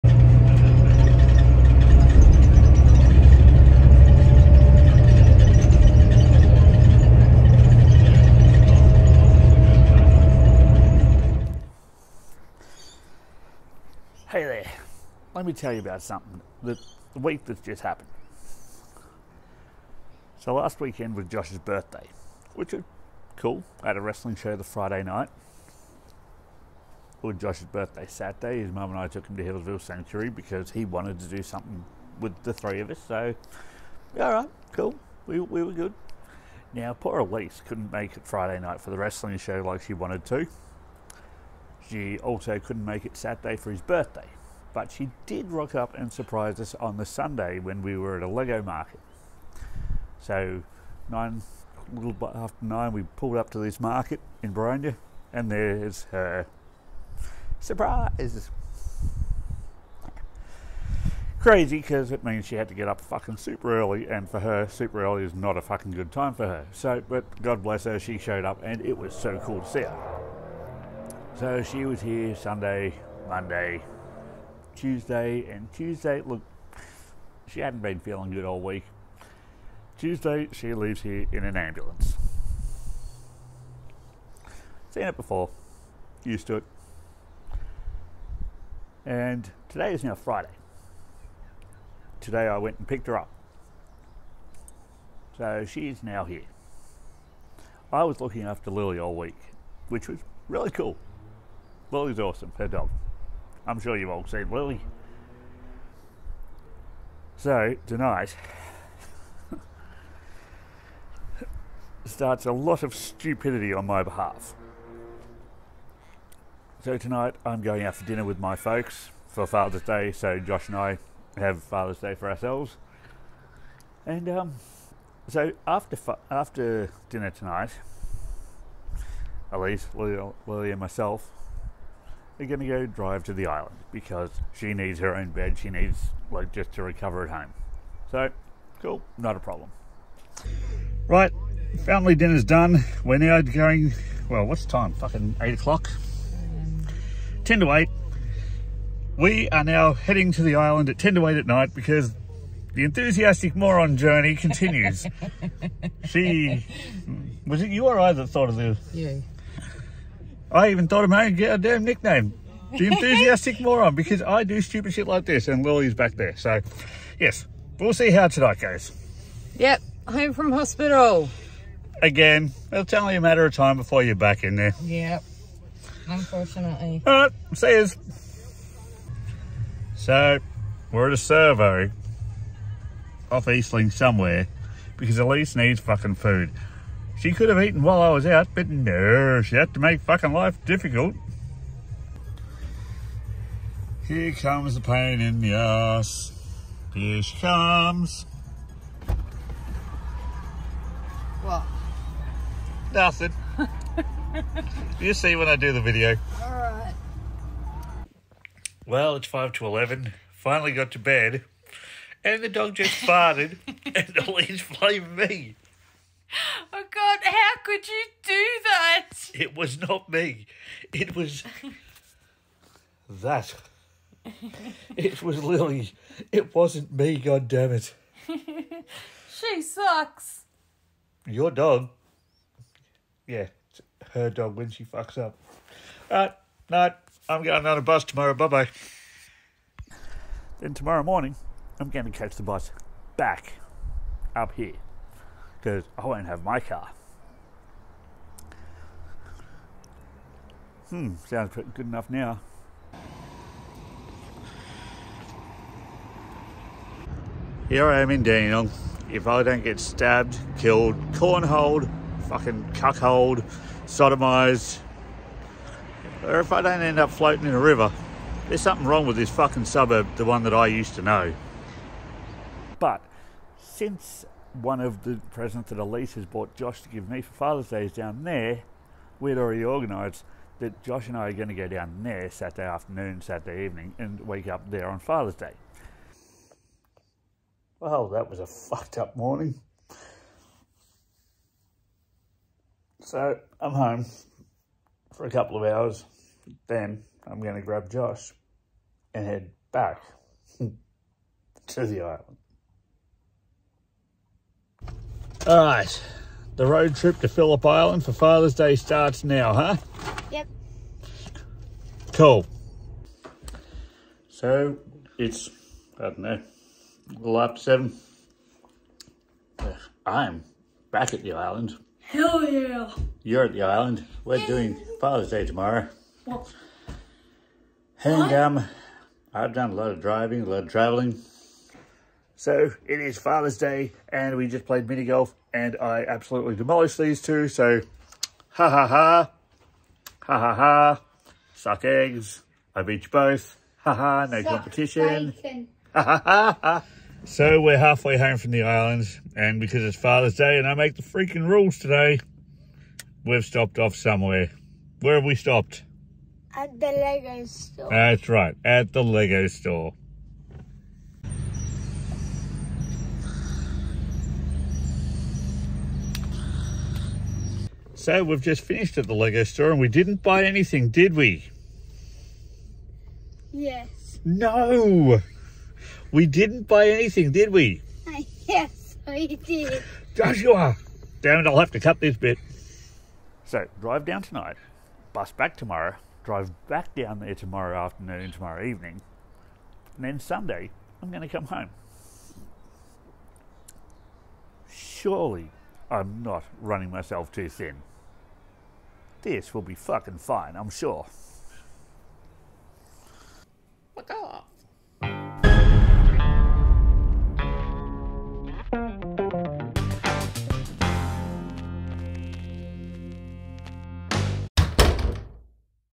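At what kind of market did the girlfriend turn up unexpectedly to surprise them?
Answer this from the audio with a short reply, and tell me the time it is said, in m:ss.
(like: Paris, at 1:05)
Lego market, at 0:48.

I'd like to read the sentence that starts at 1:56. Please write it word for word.
So, tonight I'm going out for dinner with my folks for Father's Day, so Josh and I have Father's Day for ourselves.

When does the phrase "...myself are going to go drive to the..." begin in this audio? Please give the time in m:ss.
2:10.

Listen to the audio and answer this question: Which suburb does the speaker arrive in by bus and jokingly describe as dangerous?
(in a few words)
Dandenong.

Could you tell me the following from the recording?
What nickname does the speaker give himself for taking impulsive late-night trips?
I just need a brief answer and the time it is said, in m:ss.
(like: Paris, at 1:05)
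the enthusiastic moron, at 2:42.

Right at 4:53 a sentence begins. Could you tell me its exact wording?
So I'm home for a couple of hours.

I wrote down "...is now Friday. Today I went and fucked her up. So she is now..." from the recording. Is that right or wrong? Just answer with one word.
wrong.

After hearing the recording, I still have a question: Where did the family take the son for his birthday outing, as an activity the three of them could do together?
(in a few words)
Healesville Sanctuary.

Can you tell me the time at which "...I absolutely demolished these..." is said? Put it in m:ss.
5:35.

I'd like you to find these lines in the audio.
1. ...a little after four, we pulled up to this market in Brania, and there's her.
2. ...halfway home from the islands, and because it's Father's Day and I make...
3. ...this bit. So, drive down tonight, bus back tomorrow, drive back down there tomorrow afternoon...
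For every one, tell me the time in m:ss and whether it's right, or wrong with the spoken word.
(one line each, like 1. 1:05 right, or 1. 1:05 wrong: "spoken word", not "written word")
1. 0:51 wrong: "nine", not "four"
2. 5:47 right
3. 6:22 right.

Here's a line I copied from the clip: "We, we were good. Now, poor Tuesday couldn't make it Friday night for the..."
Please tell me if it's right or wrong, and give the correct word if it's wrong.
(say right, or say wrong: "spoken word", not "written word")
wrong: "Elise", not "Tuesday".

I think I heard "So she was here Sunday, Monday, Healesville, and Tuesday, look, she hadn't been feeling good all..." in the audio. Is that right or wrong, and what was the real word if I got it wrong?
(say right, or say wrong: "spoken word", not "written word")
wrong: "Tuesday", not "Healesville".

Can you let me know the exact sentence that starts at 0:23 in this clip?
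I had a wrestling show the Friday night.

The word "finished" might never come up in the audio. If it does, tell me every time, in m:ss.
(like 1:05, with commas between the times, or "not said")
6:08.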